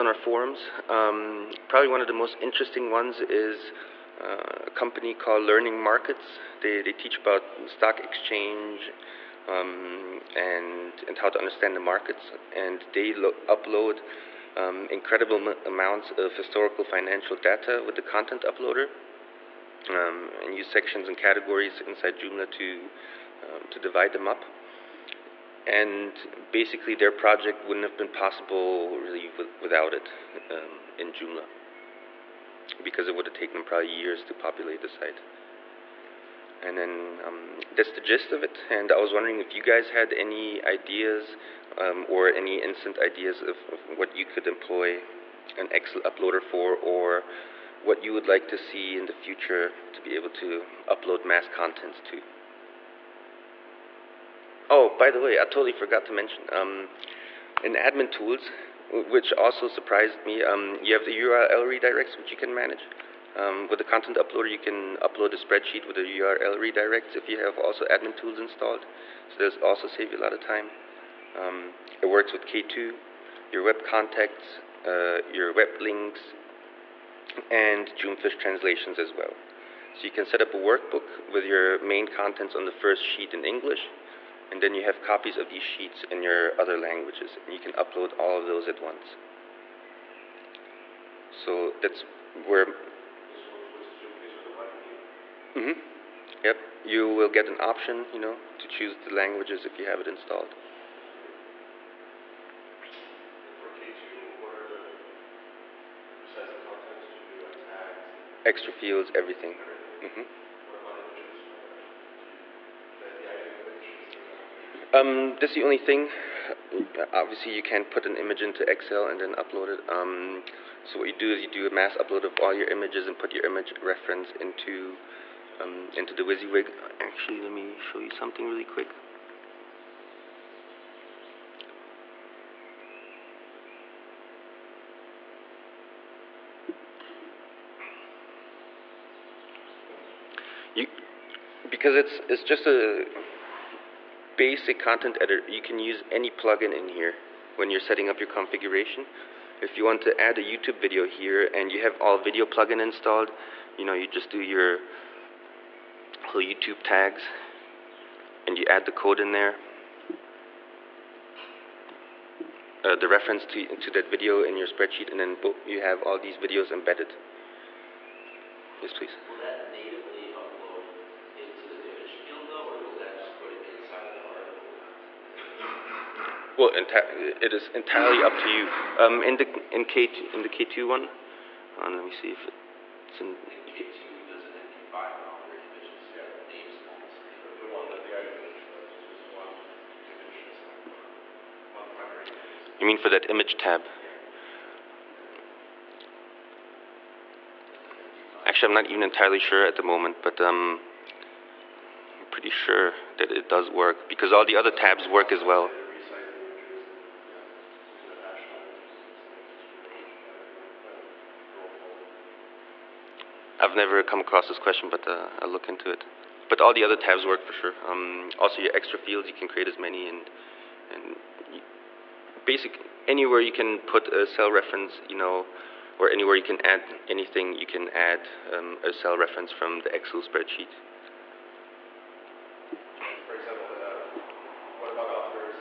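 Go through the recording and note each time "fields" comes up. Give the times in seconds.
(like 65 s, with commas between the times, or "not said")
108 s, 218 s.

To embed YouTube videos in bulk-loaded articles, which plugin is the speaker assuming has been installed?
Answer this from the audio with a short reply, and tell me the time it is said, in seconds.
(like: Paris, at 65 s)
All video plugin, at 151 s.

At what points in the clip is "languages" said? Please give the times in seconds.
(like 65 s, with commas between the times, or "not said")
86 s, 99 s.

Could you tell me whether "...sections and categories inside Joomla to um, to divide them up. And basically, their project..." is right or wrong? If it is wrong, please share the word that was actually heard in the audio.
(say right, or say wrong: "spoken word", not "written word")
right.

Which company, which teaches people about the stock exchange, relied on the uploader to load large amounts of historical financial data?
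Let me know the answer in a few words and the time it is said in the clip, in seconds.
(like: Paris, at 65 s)
Learning Markets, at 5 s.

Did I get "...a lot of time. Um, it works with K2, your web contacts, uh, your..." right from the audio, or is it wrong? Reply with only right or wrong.
right.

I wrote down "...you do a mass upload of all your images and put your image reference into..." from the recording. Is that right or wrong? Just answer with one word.
right.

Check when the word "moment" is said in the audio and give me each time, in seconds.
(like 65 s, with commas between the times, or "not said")
199 s.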